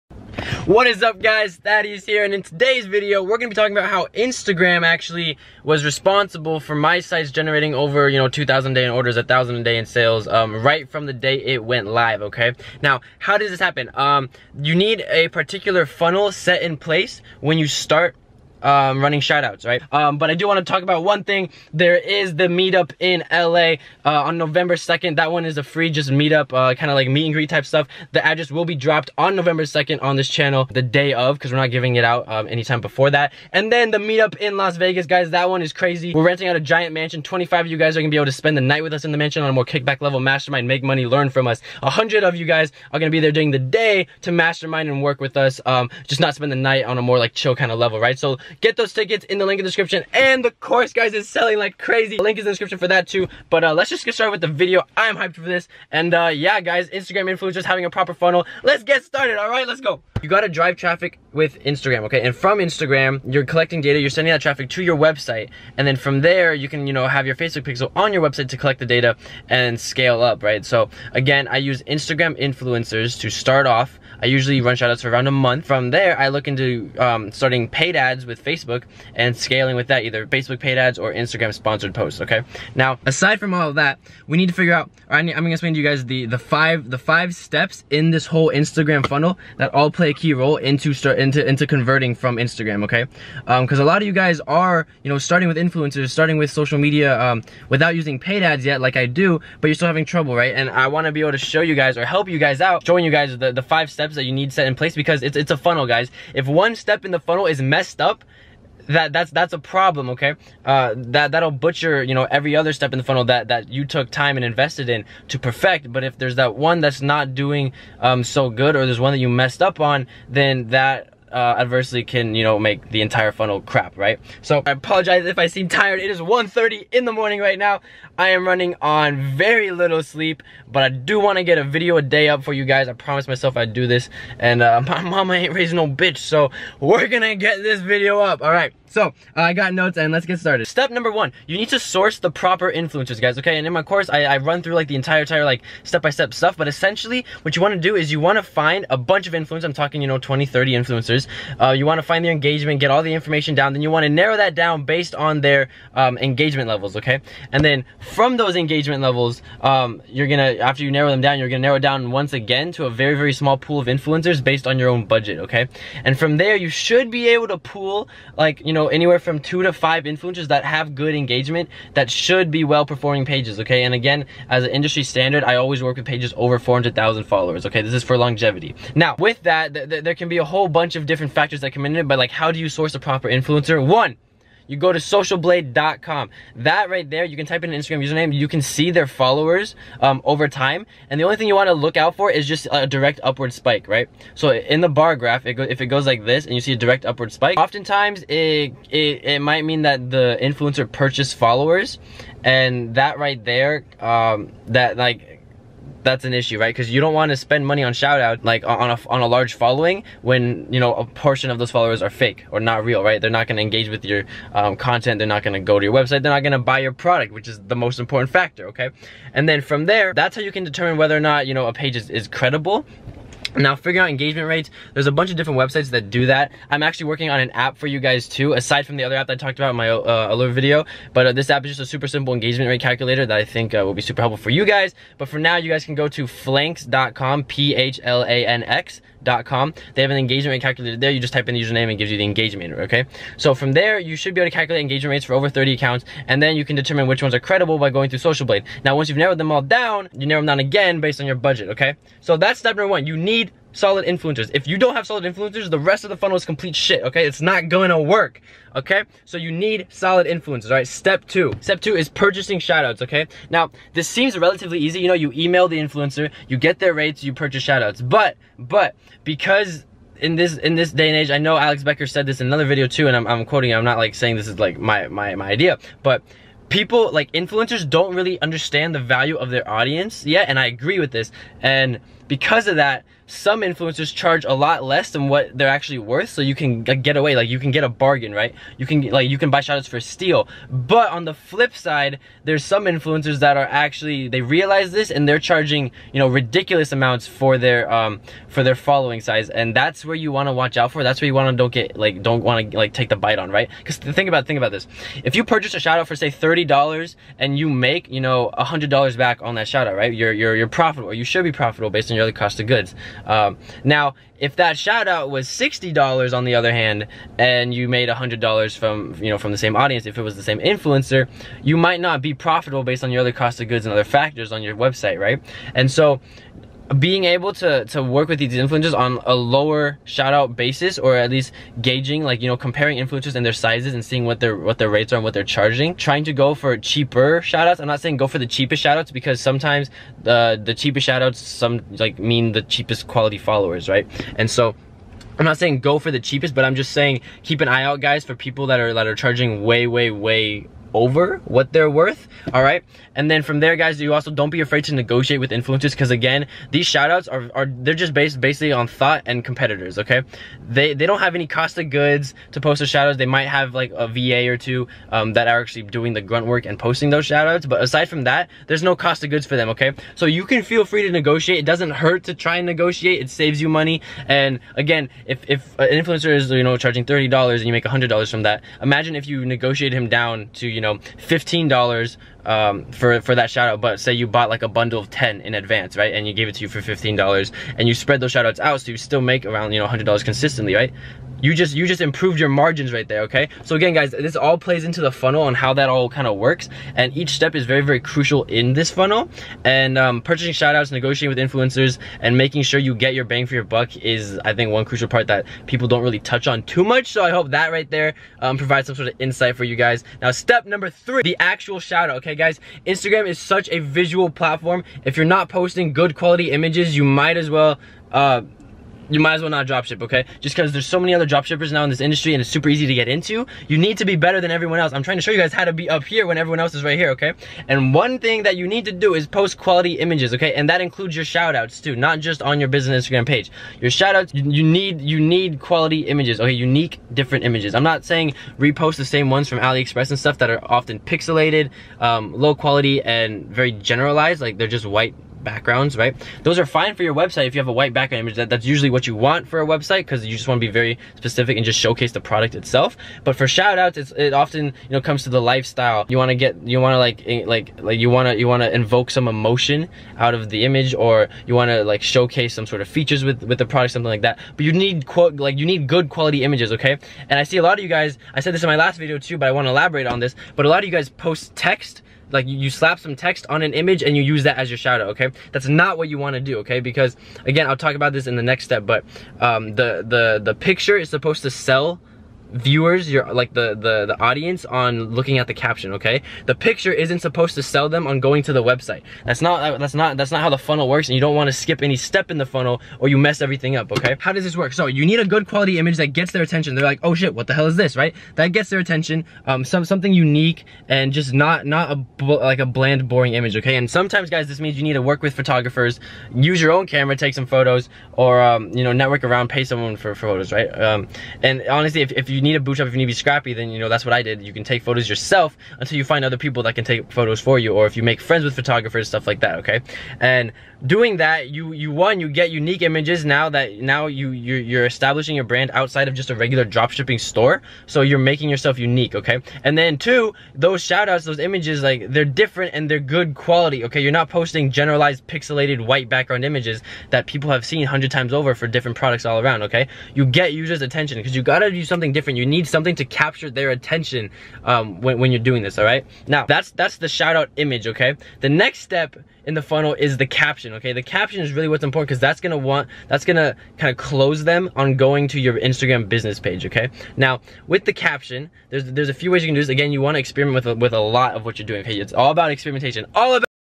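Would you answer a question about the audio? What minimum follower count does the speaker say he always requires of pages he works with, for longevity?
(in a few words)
400,000.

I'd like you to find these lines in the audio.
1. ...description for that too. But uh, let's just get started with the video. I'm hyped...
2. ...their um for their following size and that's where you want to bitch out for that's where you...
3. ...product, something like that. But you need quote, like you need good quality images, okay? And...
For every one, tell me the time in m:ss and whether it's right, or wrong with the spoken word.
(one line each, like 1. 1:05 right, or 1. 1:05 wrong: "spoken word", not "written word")
1. 0:52 right
2. 4:57 wrong: "watch", not "bitch"
3. 7:43 right.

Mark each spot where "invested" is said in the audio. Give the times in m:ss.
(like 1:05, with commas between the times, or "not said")
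1:54.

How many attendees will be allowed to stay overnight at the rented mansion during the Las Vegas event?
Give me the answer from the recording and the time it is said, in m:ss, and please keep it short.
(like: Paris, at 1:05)
25, at 0:37.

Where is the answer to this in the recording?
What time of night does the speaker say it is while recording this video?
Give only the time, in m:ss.
2:06.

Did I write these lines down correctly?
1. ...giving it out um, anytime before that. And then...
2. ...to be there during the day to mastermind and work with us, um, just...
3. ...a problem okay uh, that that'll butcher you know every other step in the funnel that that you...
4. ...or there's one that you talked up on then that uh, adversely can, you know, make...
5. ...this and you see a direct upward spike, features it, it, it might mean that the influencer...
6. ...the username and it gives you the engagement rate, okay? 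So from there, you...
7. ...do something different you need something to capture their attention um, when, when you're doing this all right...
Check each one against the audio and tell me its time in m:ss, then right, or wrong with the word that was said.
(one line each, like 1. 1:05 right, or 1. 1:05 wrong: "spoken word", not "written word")
1. 0:31 right
2. 0:43 right
3. 1:49 right
4. 1:58 wrong: "messed", not "talked"
5. 3:16 wrong: "oftentimes", not "features"
6. 4:01 right
7. 9:01 right.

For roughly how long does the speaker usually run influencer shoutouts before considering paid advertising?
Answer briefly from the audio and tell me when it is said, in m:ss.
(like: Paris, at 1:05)
a month, at 1:15.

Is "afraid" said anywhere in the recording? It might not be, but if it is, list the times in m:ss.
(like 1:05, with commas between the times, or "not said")
5:54.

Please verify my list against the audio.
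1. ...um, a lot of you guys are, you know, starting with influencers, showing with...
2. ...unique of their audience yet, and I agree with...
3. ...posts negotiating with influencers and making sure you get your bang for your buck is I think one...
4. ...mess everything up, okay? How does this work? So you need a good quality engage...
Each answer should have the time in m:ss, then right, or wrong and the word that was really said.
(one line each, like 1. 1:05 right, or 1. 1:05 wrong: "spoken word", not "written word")
1. 1:33 wrong: "starting", not "showing"
2. 4:38 wrong: "value", not "unique"
3. 6:40 wrong: "shoutouts", not "posts"
4. 8:13 wrong: "image", not "engage".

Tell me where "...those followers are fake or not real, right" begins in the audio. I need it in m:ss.
3:31.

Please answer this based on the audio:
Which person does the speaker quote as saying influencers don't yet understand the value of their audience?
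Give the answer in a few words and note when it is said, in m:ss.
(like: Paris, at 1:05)
Alex Becker, at 4:31.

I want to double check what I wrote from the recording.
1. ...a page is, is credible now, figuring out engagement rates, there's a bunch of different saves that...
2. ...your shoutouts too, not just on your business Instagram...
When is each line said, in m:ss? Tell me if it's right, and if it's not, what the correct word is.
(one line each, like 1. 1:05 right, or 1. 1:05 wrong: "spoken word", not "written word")
1. 3:41 wrong: "websites", not "saves"
2. 7:11 right.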